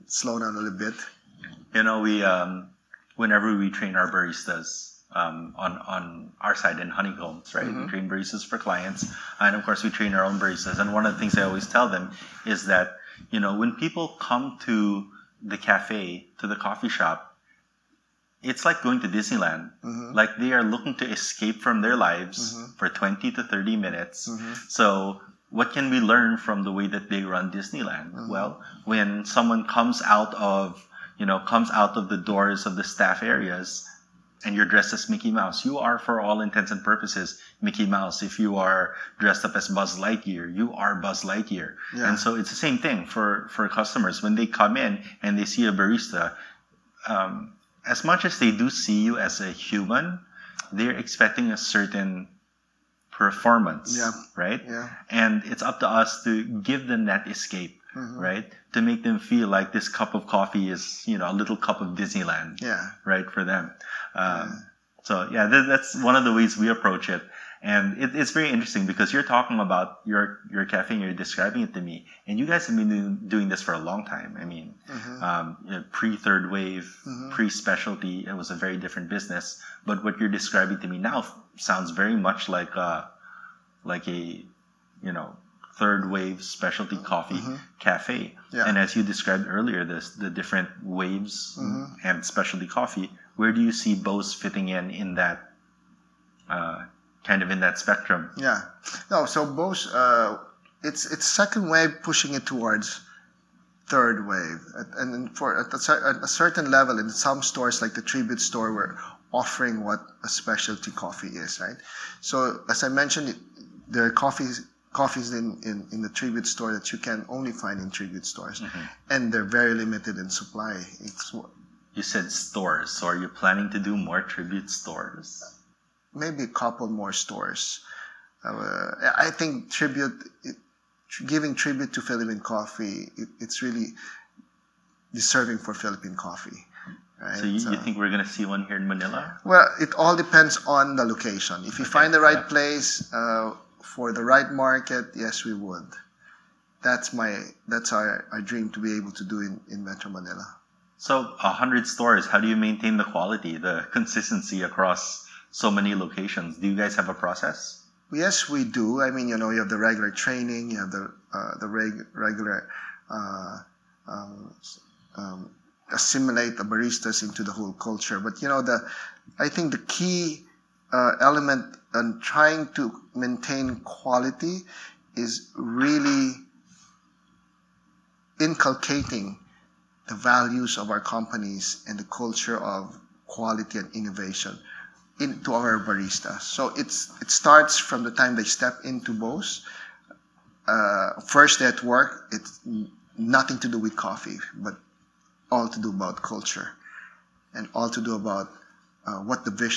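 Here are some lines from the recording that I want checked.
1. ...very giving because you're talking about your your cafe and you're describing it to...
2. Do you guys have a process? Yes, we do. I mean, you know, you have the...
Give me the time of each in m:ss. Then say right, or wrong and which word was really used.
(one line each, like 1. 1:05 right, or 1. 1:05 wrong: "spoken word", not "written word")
1. 1:08 wrong: "interesting", not "giving"
2. 2:36 right.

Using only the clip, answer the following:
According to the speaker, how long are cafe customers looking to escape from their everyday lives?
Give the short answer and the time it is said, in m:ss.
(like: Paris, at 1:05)
20 to 30 minutes, at 0:22.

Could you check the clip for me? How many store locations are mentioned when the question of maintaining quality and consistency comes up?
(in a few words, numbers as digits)
100.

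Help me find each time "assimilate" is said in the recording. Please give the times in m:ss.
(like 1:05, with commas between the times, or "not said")
2:45.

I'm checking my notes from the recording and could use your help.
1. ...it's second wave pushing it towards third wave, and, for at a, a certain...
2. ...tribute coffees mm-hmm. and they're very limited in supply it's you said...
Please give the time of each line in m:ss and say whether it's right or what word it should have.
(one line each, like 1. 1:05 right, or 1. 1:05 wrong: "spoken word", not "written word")
1. 1:41 right
2. 1:57 wrong: "stores", not "coffees".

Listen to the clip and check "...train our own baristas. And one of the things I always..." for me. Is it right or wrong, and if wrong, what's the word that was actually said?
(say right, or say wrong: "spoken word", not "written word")
right.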